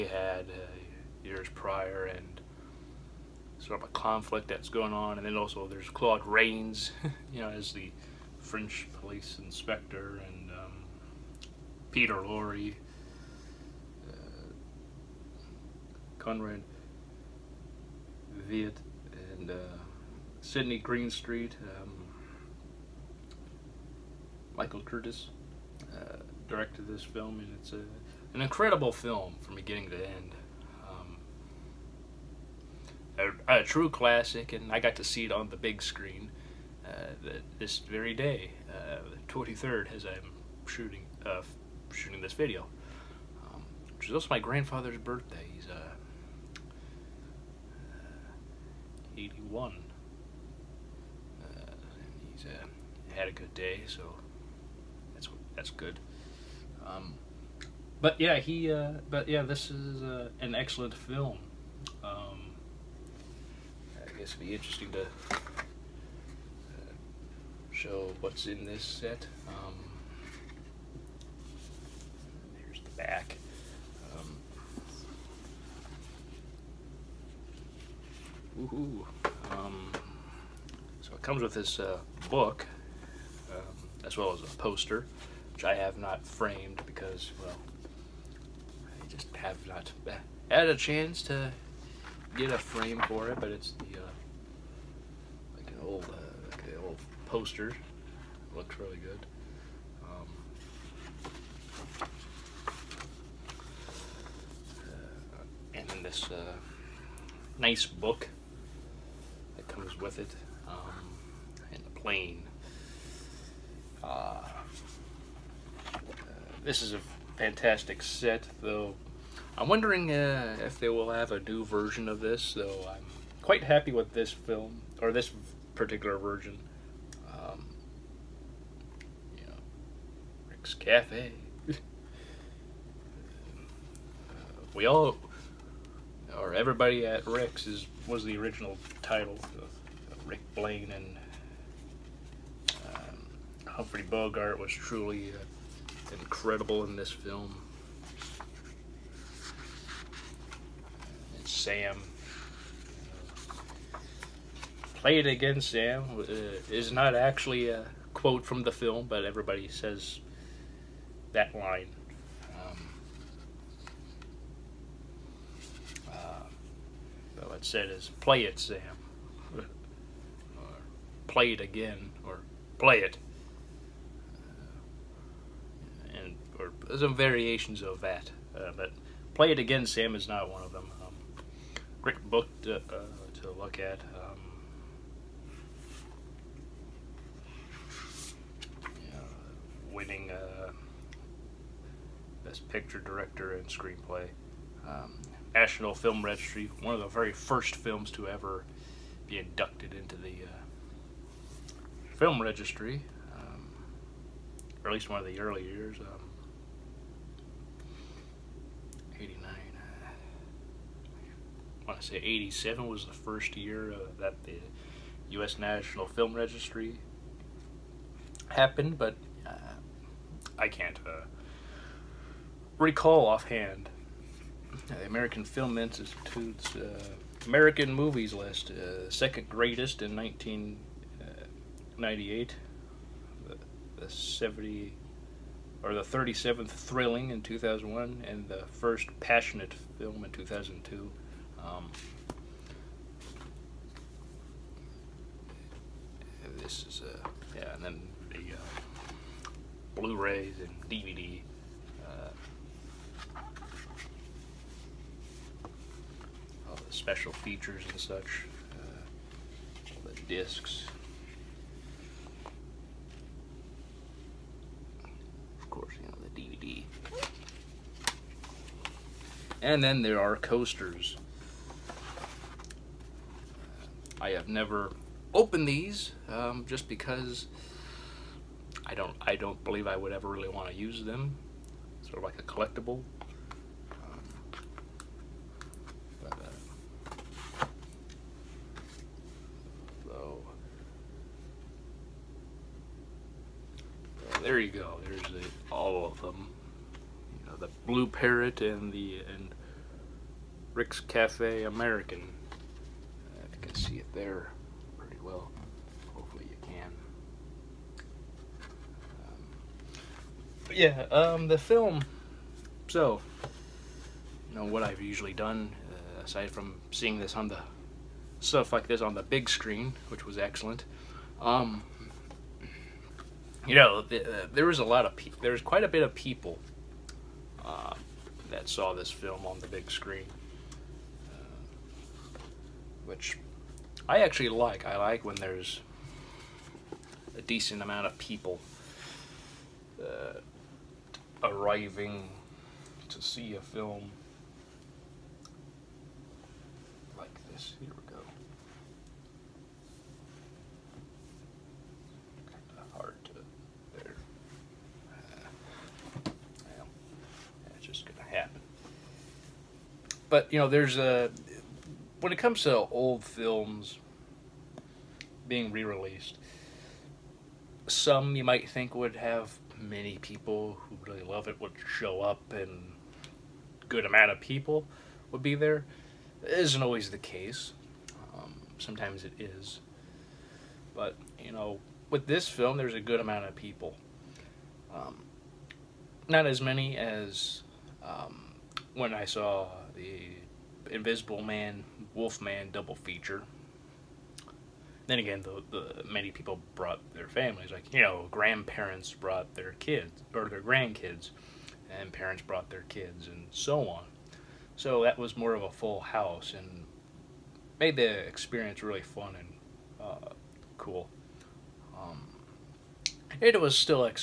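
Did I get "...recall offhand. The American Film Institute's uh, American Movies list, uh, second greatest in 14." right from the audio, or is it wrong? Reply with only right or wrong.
wrong.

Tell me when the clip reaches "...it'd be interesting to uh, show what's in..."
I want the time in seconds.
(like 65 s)
64 s.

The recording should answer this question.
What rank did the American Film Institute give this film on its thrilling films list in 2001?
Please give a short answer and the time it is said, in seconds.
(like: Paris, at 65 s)
37th, at 236 s.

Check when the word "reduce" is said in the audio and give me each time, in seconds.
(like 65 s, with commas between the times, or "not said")
not said.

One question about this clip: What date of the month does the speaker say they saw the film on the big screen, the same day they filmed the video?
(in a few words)
23rd.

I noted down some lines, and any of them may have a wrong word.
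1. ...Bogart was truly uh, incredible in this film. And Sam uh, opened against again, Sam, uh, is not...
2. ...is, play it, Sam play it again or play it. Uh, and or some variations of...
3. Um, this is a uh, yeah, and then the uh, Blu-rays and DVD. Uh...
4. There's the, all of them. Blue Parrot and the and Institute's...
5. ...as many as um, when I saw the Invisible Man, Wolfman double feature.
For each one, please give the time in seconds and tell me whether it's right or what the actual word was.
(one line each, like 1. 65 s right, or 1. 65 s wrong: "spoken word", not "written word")
1. 144 s wrong: "played", not "opened"
2. 167 s right
3. 241 s right
4. 295 s wrong: "Rick", not "Institute"
5. 386 s right.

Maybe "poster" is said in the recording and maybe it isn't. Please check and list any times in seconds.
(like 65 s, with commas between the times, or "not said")
84 s, 97 s.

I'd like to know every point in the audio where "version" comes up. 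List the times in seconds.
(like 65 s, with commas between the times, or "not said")
121 s, 126 s.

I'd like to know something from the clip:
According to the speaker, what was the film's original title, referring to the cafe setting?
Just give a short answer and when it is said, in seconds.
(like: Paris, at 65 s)
Everybody at Rick's, at 136 s.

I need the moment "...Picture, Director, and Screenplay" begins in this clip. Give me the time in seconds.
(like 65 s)
192 s.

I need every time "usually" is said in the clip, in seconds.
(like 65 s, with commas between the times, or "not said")
315 s.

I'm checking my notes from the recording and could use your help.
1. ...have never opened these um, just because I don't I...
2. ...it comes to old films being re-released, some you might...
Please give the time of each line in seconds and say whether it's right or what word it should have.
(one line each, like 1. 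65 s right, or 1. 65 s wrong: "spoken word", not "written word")
1. 274 s right
2. 362 s right.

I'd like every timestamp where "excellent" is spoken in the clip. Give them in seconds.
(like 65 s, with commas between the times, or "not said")
60 s, 320 s.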